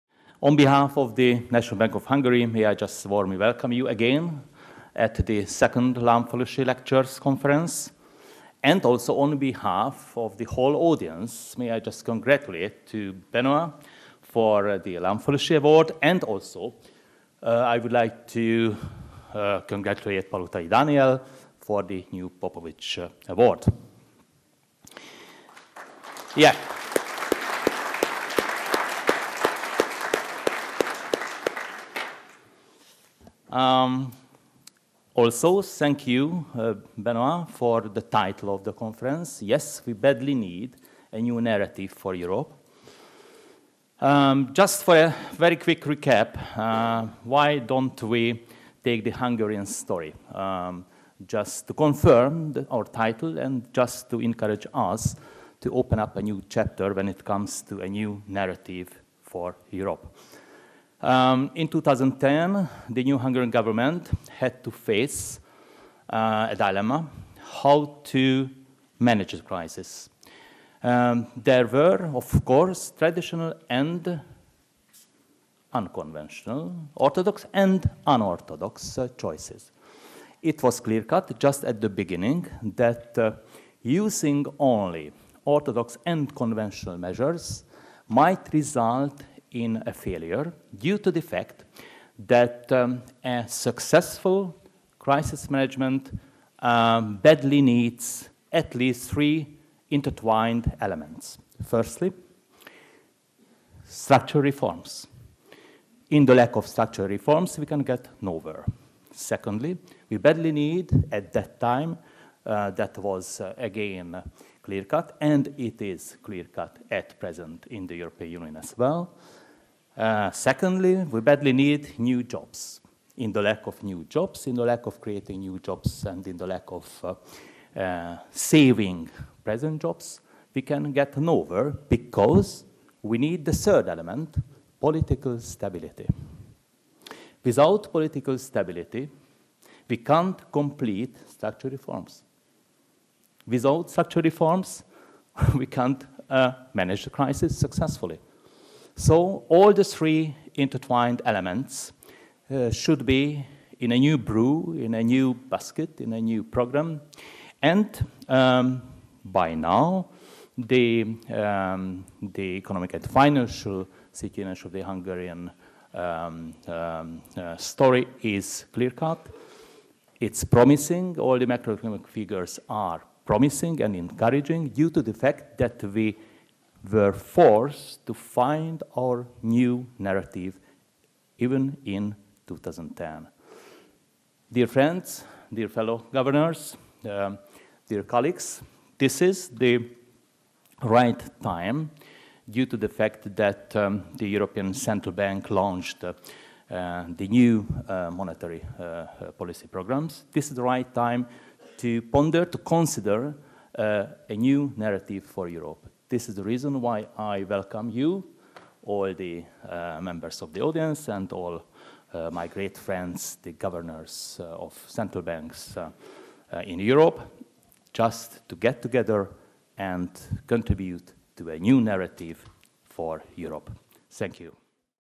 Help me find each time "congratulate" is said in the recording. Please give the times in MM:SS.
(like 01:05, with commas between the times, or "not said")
00:12, 00:19.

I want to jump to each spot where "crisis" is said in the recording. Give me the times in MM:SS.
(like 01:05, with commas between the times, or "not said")
01:09, 01:34, 02:27.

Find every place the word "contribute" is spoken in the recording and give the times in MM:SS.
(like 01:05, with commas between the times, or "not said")
03:40.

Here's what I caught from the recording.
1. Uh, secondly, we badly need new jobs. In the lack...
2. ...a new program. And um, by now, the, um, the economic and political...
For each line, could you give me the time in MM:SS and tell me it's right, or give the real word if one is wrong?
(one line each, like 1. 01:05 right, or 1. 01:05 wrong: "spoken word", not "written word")
1. 01:59 right
2. 02:36 wrong: "financial", not "political".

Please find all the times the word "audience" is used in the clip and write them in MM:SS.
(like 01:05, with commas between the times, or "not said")
00:10, 03:30.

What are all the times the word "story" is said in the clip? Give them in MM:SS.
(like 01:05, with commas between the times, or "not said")
00:49, 02:47.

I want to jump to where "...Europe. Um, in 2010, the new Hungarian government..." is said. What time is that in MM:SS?
00:59.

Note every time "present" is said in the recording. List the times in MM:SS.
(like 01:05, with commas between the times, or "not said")
01:57, 02:09.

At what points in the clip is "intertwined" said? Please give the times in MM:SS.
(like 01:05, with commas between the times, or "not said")
01:39, 02:30.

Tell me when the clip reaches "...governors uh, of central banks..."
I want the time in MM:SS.
03:33.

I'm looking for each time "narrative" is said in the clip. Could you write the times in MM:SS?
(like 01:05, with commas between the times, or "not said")
00:41, 00:58, 02:59, 03:24, 03:41.